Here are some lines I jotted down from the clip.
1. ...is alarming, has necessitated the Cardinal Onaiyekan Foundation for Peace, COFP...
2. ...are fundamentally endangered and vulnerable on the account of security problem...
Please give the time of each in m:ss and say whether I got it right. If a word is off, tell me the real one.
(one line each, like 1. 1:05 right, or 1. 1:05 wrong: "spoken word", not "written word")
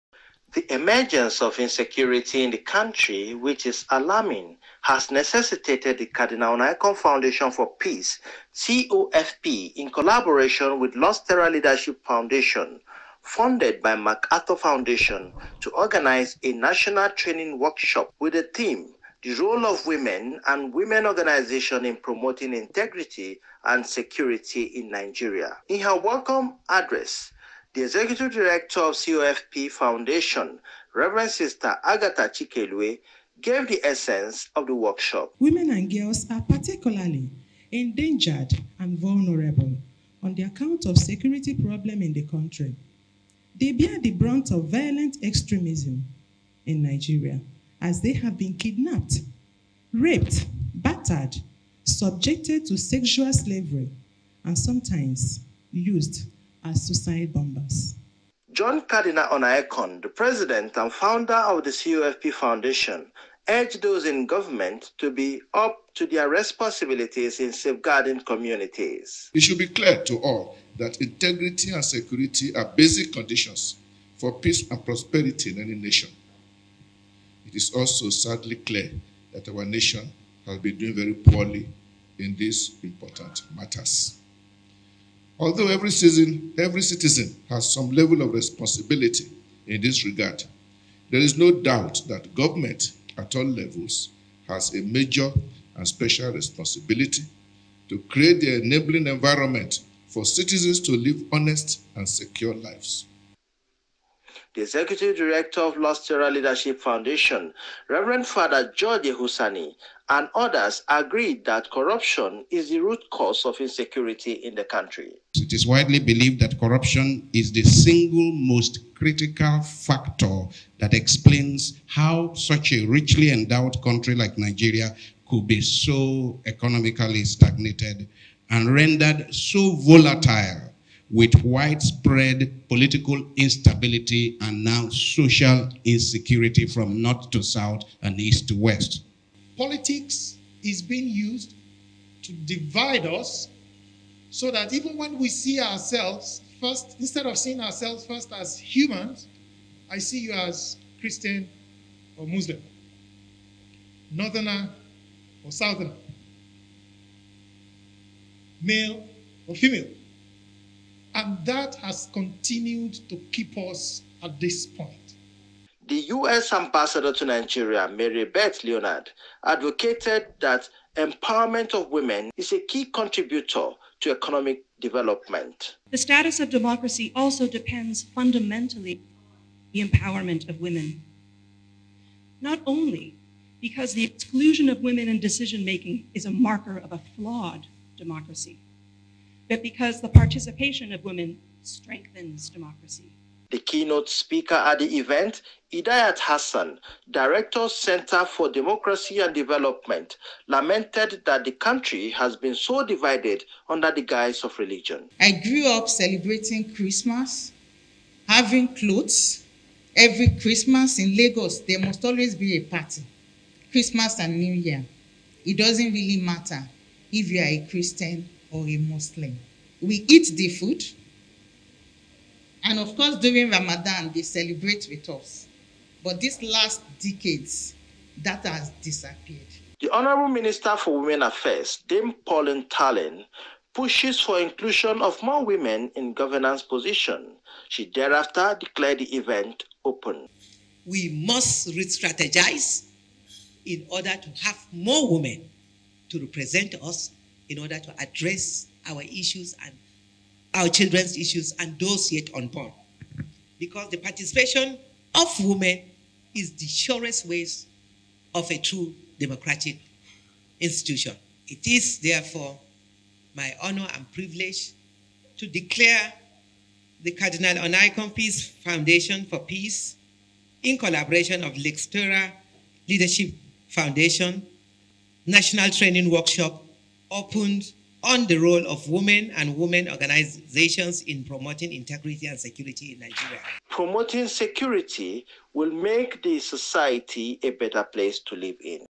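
1. 0:03 right
2. 0:36 wrong: "particularly", not "fundamentally".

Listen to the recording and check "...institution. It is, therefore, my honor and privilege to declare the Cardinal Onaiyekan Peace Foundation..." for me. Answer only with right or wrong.
right.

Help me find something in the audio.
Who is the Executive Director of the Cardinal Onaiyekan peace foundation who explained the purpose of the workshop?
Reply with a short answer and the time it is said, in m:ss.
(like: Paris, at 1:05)
Agatha Chikelue, at 0:31.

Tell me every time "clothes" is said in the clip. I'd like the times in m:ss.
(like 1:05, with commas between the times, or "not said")
3:28.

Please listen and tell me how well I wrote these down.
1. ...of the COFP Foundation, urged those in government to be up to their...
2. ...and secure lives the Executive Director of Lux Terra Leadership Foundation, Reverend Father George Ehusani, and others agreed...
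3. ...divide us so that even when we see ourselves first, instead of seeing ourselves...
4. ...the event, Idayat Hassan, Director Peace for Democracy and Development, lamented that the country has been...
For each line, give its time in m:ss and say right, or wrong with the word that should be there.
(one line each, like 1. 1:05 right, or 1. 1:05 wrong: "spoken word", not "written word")
1. 1:01 right
2. 1:41 right
3. 2:22 right
4. 3:14 wrong: "Center", not "Peace".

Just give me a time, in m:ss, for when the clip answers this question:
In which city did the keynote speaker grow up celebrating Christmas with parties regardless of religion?
3:31.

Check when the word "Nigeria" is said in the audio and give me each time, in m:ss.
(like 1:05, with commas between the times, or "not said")
0:24, 0:46, 2:04, 2:47, 4:42.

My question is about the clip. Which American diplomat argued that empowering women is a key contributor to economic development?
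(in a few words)
Mary Beth Leonard.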